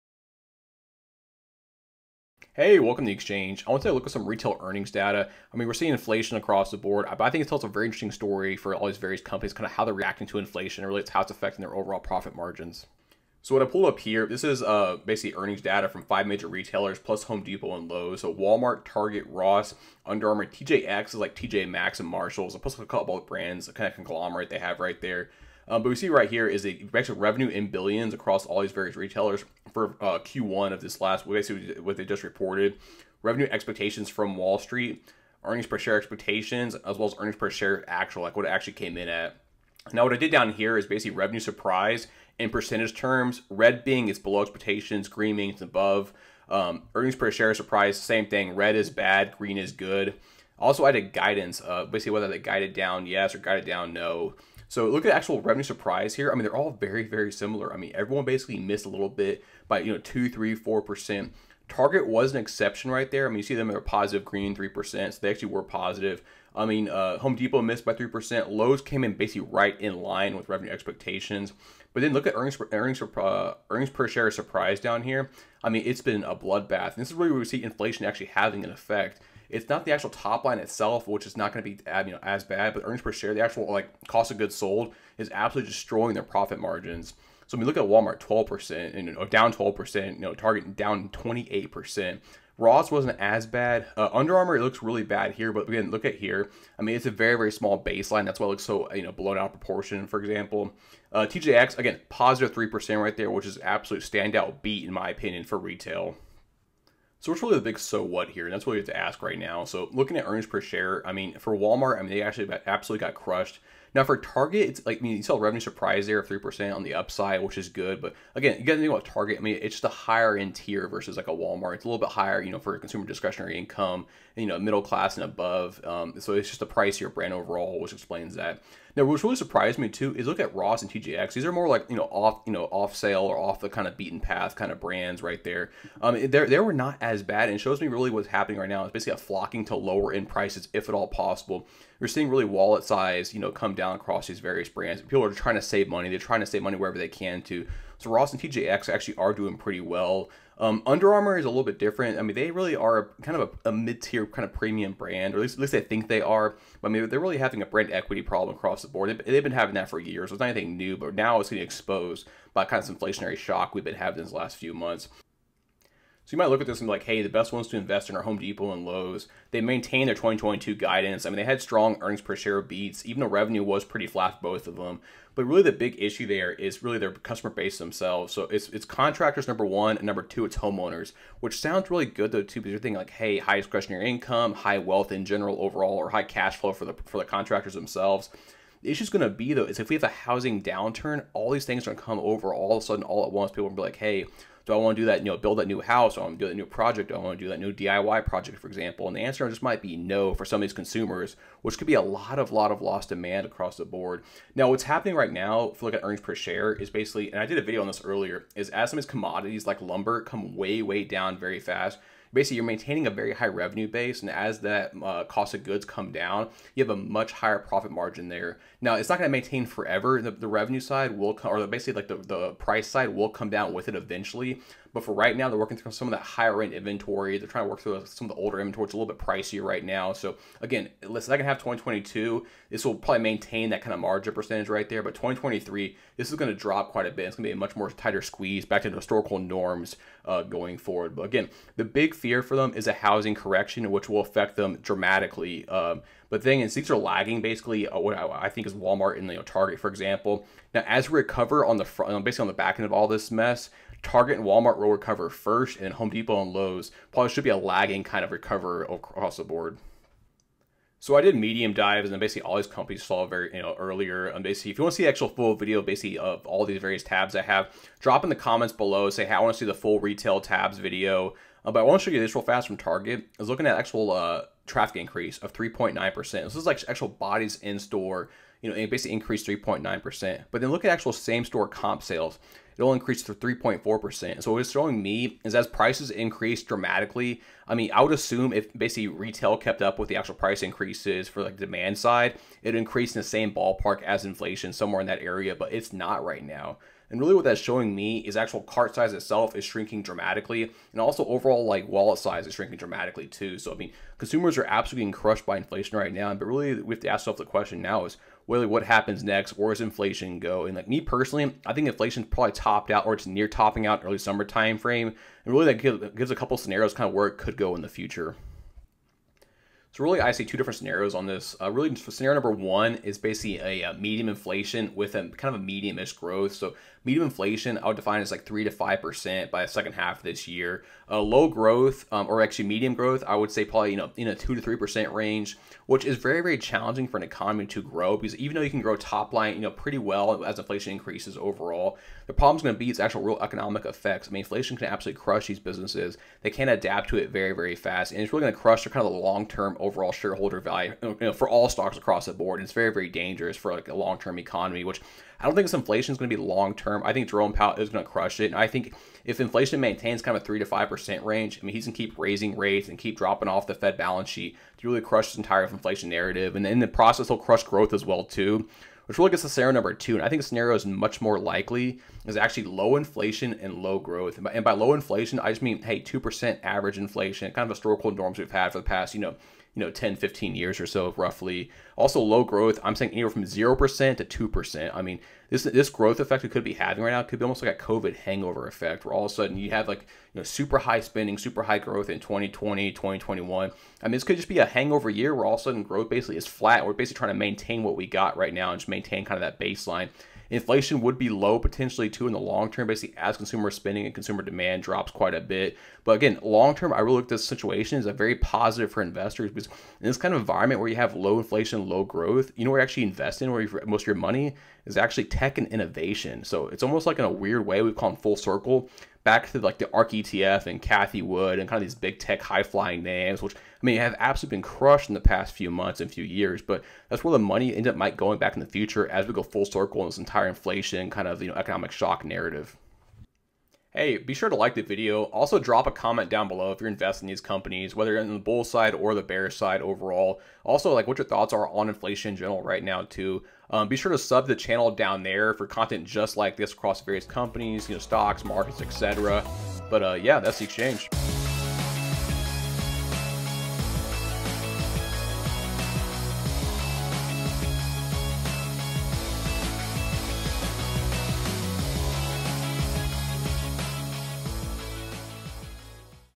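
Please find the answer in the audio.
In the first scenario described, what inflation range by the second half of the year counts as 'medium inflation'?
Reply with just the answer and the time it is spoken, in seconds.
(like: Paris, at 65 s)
3 to 5%, at 328 s.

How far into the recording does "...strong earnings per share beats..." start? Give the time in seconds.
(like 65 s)
171 s.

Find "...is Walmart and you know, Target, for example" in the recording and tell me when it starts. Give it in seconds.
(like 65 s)
248 s.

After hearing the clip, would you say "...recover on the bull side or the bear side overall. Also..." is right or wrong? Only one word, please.
wrong.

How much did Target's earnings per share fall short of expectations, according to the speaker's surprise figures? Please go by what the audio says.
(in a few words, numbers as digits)
28%.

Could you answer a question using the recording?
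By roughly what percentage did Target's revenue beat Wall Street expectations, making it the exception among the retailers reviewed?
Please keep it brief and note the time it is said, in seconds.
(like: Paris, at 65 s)
3%, at 63 s.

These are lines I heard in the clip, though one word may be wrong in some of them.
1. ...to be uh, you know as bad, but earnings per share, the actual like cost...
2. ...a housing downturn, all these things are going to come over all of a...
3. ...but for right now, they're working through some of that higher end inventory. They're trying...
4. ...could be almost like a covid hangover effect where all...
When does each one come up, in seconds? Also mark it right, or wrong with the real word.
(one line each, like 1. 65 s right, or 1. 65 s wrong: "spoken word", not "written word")
1. 81 s right
2. 190 s right
3. 224 s right
4. 387 s right.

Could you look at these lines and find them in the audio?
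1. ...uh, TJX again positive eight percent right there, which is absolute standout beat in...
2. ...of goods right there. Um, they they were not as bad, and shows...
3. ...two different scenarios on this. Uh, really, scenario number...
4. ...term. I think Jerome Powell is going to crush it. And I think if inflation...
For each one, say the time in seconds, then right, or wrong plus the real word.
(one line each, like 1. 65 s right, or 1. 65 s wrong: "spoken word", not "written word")
1. 101 s wrong: "three", not "eight"
2. 134 s wrong: "brands", not "goods"
3. 320 s right
4. 356 s right.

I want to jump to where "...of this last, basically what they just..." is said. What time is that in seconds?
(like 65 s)
30 s.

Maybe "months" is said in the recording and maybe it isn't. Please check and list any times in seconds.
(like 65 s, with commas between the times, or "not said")
164 s, 425 s.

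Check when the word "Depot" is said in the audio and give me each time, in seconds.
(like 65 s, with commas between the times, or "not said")
17 s, 67 s, 168 s, 256 s.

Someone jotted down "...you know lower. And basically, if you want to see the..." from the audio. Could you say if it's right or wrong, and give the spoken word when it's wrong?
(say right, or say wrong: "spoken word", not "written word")
wrong: "earlier", not "lower".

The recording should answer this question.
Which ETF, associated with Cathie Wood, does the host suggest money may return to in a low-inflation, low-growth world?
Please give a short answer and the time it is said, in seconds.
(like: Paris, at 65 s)
Ark ETF, at 419 s.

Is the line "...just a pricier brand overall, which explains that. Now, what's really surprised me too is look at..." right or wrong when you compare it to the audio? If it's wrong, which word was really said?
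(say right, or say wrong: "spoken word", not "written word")
right.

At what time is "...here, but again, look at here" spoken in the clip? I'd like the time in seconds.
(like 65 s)
95 s.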